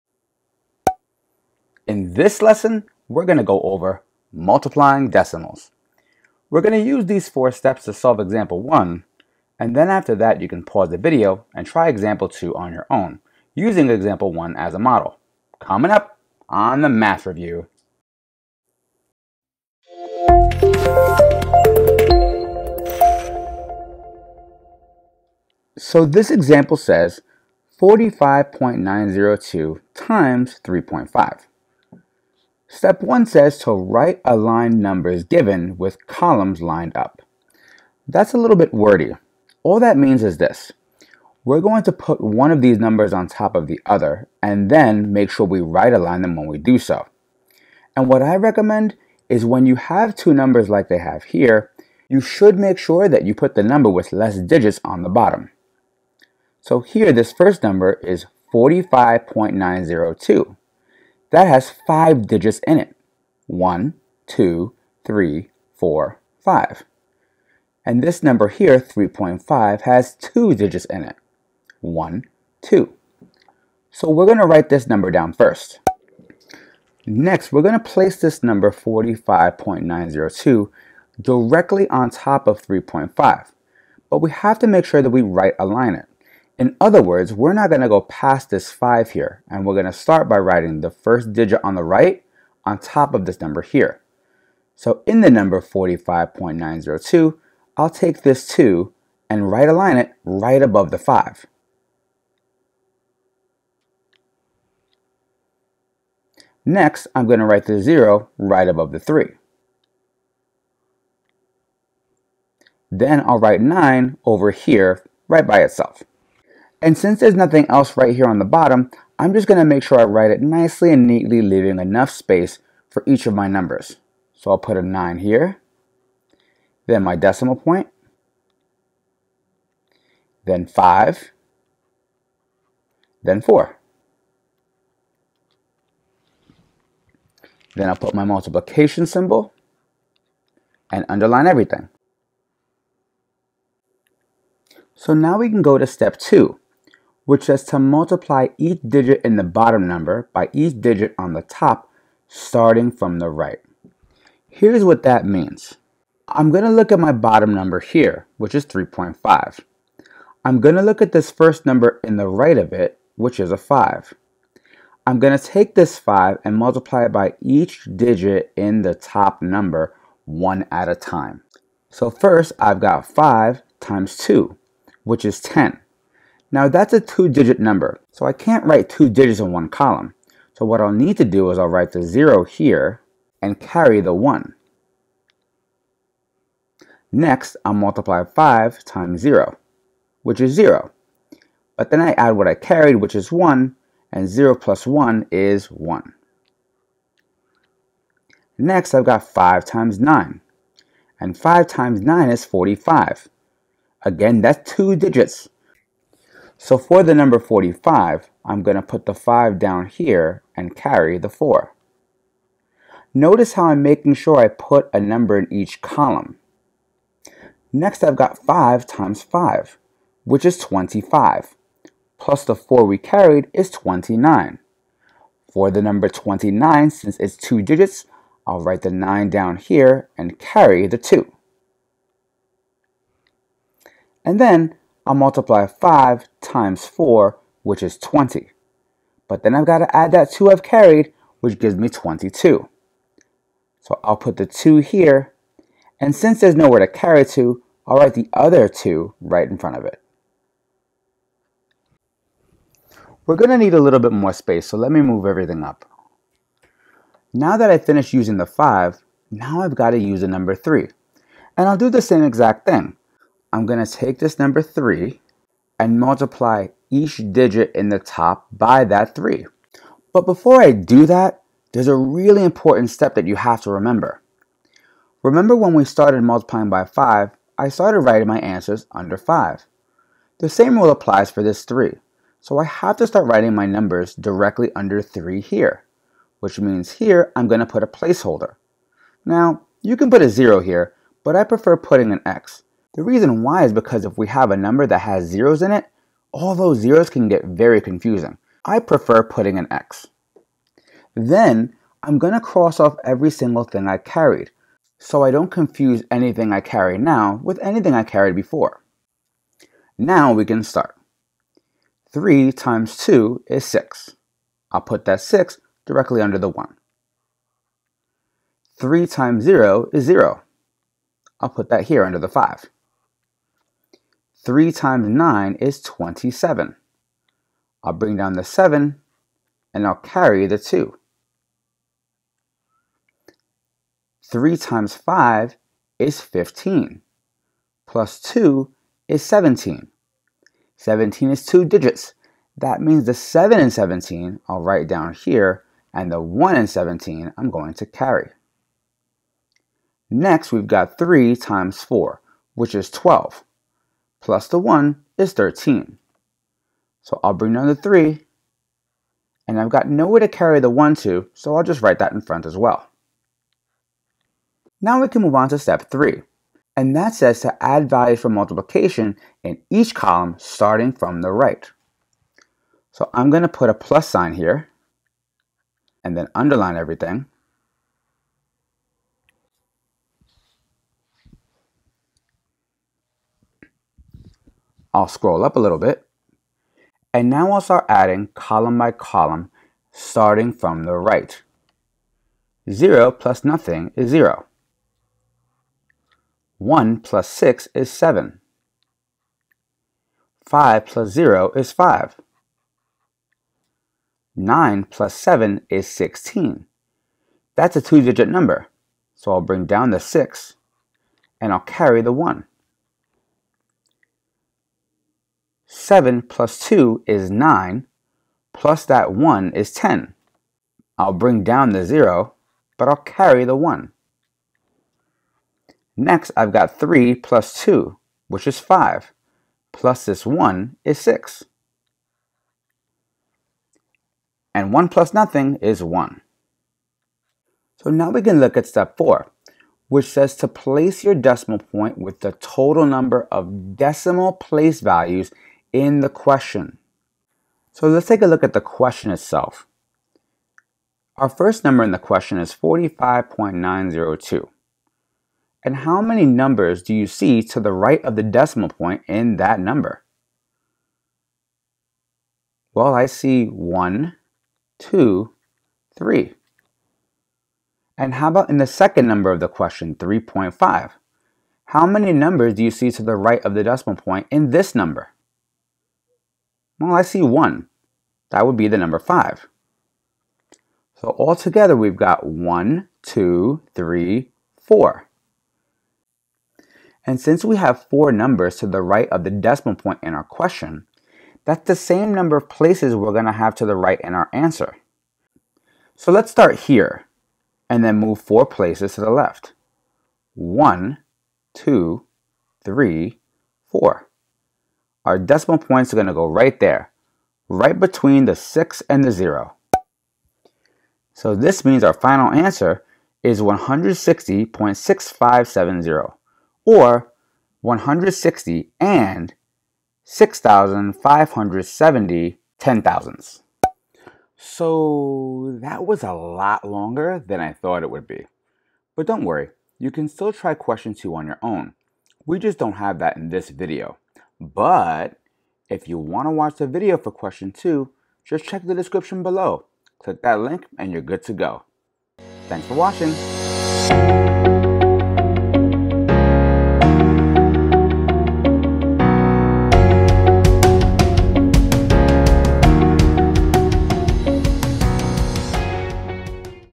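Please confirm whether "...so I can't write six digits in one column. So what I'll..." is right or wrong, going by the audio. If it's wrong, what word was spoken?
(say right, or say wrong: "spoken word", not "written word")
wrong: "two", not "six".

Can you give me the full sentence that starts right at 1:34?
So in the number 45.902, I'll take this 2 and right align it right above the 5.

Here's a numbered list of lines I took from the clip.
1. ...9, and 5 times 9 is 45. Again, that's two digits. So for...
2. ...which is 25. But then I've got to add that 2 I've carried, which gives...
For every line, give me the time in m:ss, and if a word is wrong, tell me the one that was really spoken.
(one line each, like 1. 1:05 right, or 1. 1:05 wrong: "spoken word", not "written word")
1. 3:20 right
2. 3:57 wrong: "20", not "25".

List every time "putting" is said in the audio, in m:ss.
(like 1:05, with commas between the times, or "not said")
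4:51, 4:59.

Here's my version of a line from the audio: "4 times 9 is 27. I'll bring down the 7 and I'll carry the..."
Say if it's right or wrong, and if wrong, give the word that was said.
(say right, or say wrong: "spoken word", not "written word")
wrong: "3", not "4".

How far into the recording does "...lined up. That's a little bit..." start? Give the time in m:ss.
0:36.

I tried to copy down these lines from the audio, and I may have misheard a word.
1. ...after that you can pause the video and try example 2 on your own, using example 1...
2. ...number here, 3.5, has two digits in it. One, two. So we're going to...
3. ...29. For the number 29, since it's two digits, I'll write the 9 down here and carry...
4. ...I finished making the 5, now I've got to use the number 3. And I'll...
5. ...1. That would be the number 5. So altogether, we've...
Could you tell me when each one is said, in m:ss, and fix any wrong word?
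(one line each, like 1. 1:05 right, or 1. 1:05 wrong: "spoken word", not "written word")
1. 0:09 right
2. 1:08 right
3. 3:43 right
4. 4:17 wrong: "using", not "making"
5. 7:57 right.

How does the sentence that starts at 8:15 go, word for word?
So let's start here and then move four places to the left.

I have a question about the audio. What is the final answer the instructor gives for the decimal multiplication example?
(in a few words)
160.6570.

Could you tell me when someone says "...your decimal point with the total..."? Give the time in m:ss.
7:21.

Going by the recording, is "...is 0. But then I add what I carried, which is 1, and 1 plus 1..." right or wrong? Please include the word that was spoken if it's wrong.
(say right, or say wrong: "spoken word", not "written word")
wrong: "0", not "1".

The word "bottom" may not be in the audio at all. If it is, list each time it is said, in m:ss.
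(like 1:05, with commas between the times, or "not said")
0:55, 1:58, 2:29, 2:37.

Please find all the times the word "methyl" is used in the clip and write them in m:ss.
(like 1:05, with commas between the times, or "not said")
not said.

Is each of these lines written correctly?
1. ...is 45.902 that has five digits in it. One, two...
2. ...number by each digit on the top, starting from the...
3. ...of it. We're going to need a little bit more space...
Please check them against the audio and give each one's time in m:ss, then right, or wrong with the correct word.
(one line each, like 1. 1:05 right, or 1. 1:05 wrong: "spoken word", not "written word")
1. 0:58 right
2. 2:29 right
3. 4:09 right.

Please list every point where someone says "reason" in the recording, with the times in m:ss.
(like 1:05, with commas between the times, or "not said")
4:53.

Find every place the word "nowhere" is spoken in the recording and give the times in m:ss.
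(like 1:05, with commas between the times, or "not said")
4:06, 5:59.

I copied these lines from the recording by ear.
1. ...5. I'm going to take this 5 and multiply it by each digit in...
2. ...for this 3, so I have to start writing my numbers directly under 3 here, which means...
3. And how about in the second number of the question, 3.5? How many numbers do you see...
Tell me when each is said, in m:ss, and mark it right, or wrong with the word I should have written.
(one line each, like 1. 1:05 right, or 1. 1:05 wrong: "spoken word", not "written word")
1. 2:43 right
2. 4:41 right
3. 7:47 right.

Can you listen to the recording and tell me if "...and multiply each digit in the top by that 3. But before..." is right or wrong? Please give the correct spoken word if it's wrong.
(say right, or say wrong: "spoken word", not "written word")
right.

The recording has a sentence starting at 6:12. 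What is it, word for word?
So I'm going to put a plus sign here, and then underline everything.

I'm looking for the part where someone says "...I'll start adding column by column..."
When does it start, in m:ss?
6:27.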